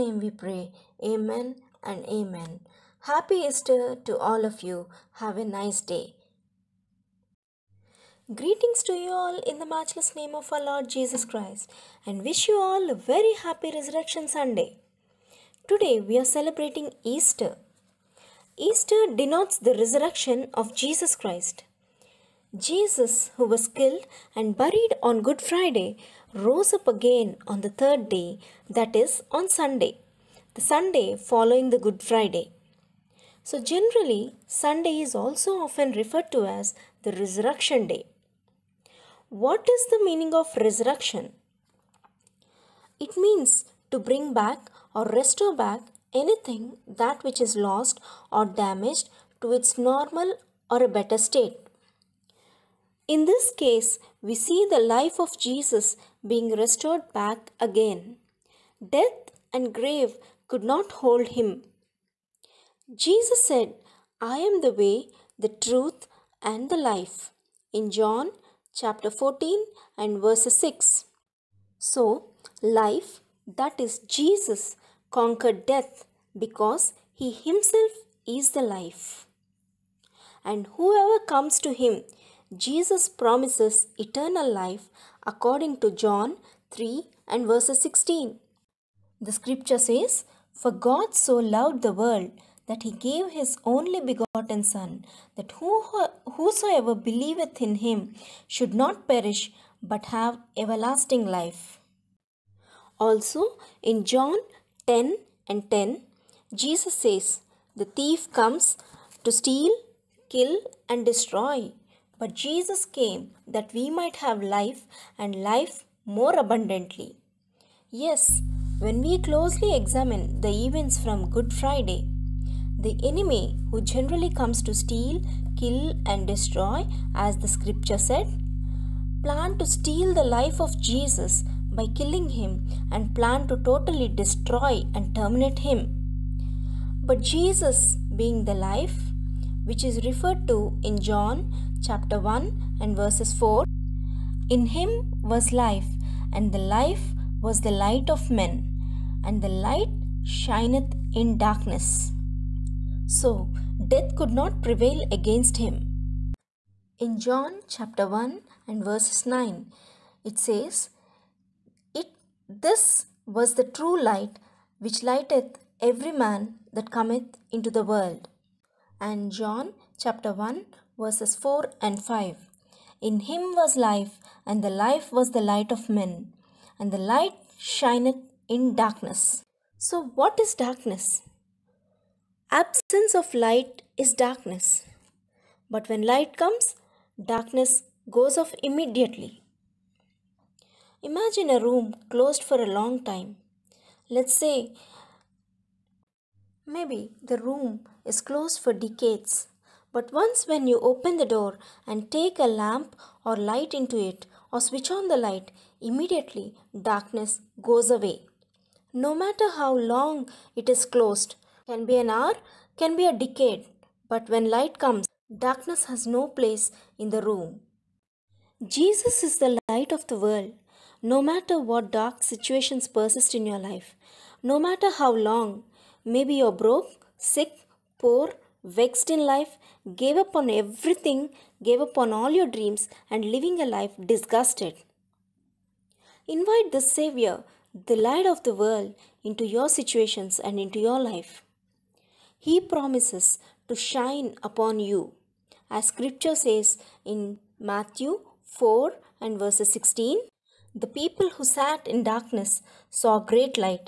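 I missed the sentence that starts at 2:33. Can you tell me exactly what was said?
So death could not prevail against him.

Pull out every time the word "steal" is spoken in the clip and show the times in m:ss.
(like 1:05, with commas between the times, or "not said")
1:49, 2:04, 2:09.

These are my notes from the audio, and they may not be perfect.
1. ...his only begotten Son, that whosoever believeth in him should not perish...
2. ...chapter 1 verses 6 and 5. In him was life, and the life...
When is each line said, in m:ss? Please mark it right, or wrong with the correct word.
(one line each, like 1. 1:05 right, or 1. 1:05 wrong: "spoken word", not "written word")
1. 1:33 right
2. 2:49 wrong: "4", not "6".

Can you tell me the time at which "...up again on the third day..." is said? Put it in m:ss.
0:26.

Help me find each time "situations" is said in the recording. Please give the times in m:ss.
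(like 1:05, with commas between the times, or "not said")
3:42, 3:59.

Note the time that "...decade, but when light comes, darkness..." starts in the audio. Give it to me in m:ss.
3:33.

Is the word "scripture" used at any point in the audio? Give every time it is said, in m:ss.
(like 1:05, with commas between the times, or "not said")
1:29, 2:07, 4:05.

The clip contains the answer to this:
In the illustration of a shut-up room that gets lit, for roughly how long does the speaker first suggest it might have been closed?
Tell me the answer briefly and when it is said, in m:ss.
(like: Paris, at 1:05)
decades, at 3:18.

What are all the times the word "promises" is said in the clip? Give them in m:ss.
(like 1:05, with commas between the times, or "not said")
1:23, 4:02.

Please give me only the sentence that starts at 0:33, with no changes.
So, generally, Sunday is also often referred to as the Resurrection Day.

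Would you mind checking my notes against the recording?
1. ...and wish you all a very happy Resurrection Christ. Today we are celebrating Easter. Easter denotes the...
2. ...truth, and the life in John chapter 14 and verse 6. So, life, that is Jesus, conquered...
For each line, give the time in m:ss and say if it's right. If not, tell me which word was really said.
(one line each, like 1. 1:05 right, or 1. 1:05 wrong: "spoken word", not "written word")
1. 0:12 wrong: "Sunday", not "Christ"
2. 1:05 right.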